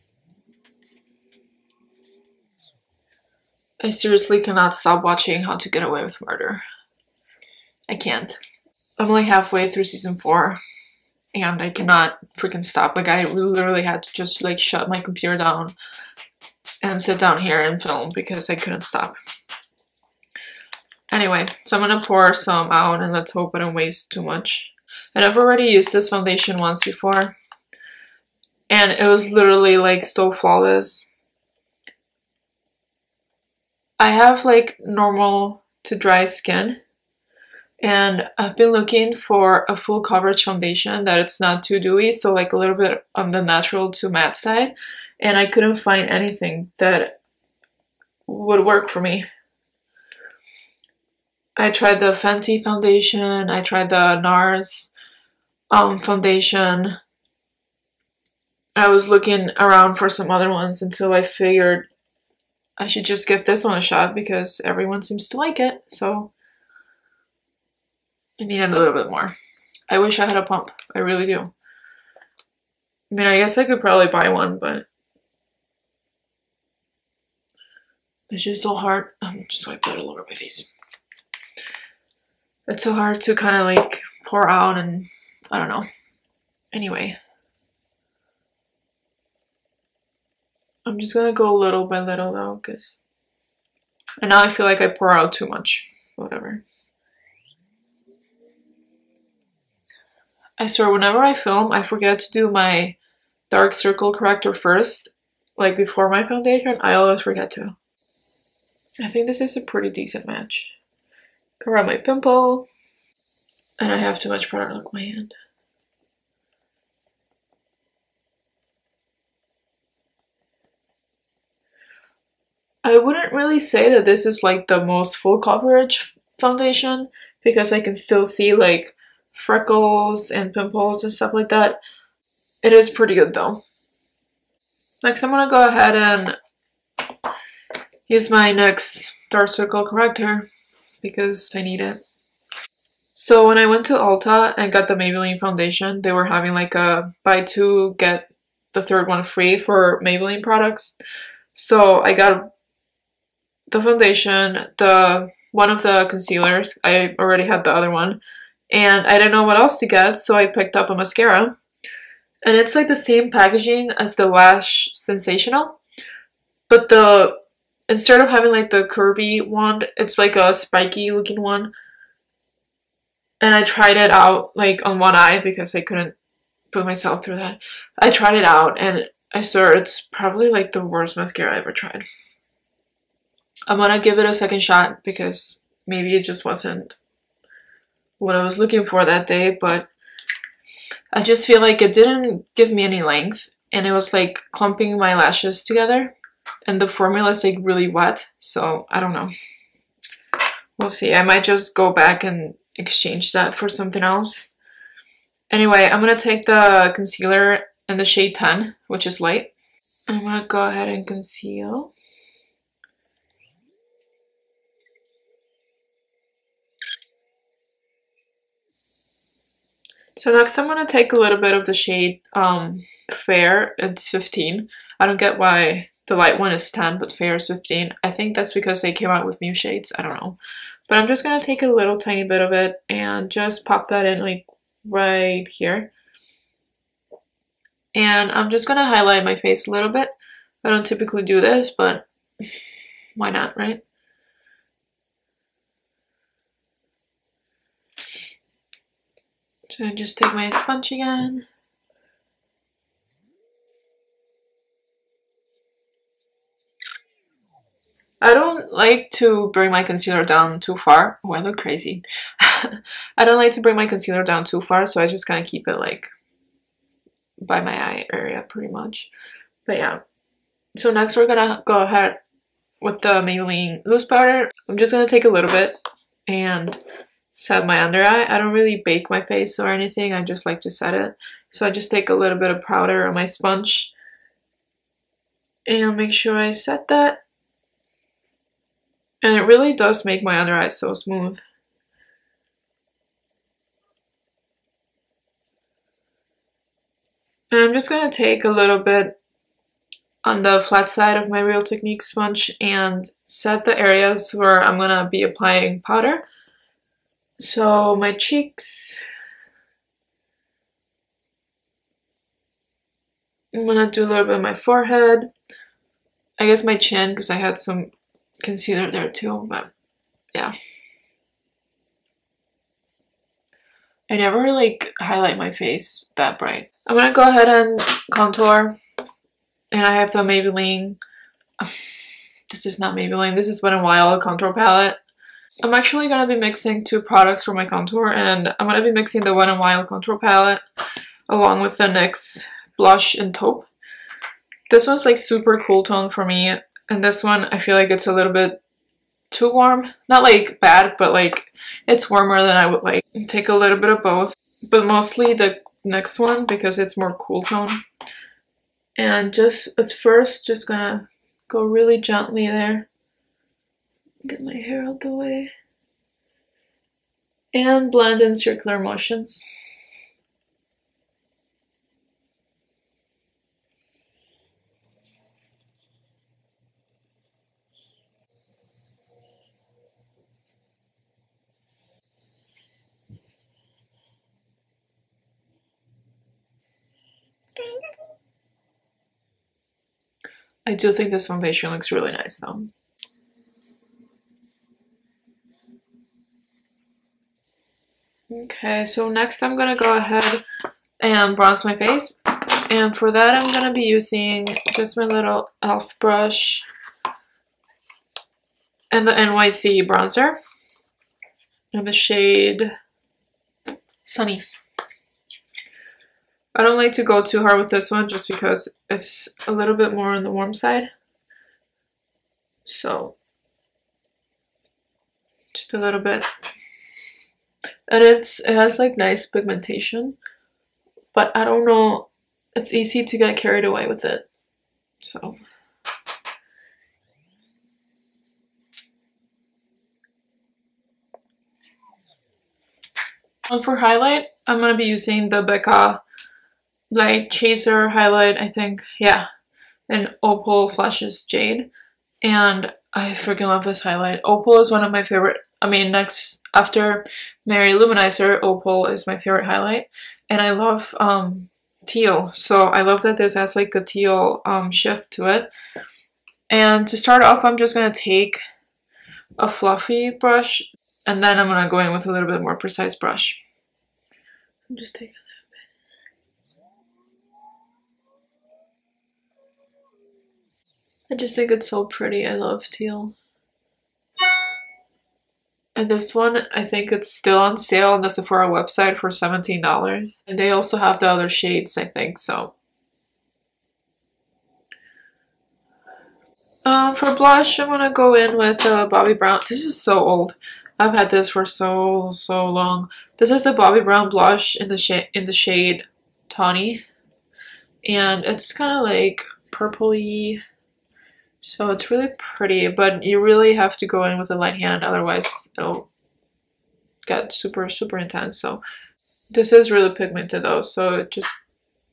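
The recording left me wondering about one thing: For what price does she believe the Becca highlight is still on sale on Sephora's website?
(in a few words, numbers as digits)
$17.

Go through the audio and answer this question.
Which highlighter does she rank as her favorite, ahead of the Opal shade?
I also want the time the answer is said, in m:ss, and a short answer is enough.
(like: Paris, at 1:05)
Mary-Lou Manizer, at 7:37.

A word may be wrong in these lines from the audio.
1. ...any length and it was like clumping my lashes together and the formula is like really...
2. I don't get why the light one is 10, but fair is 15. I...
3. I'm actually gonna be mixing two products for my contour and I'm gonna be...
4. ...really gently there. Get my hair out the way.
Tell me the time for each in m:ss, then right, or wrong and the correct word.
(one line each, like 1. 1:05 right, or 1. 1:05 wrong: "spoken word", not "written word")
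1. 3:12 right
2. 3:44 right
3. 5:35 right
4. 6:01 right.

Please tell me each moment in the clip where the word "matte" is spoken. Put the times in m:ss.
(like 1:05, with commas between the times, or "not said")
0:44.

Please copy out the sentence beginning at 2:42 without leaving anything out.
And it's like the same packaging as the Lash Sensational.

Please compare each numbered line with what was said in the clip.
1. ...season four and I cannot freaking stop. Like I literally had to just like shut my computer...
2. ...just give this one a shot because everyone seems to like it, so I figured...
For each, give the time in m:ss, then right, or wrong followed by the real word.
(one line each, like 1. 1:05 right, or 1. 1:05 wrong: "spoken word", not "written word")
1. 0:09 right
2. 1:03 wrong: "needed", not "figured".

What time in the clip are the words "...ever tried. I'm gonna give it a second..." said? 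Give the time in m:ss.
3:01.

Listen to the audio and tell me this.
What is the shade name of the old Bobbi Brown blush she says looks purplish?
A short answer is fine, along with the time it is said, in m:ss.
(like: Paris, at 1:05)
Tawny, at 8:26.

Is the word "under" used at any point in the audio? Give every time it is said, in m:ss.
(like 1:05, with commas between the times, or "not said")
4:37, 4:50.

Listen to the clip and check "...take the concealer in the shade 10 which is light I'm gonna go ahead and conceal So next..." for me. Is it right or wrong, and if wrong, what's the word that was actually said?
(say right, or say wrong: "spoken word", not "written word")
right.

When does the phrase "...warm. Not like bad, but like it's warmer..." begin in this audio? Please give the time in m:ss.
5:49.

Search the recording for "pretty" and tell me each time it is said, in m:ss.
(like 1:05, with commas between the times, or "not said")
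1:49, 2:12, 4:28, 8:01, 8:32.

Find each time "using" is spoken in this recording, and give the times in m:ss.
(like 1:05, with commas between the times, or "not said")
6:43, 7:24.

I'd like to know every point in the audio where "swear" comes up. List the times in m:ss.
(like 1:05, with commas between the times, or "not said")
1:40, 2:59.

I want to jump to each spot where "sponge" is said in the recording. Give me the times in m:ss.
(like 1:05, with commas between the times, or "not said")
4:10, 4:43, 5:02.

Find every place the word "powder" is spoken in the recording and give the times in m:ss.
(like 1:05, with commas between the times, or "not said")
4:34, 4:42, 5:05.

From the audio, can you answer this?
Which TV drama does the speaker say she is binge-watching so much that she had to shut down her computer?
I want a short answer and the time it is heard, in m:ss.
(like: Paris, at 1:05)
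How to Get Away with Murder, at 0:05.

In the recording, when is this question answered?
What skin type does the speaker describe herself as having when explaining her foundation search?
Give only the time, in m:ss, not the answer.
0:34.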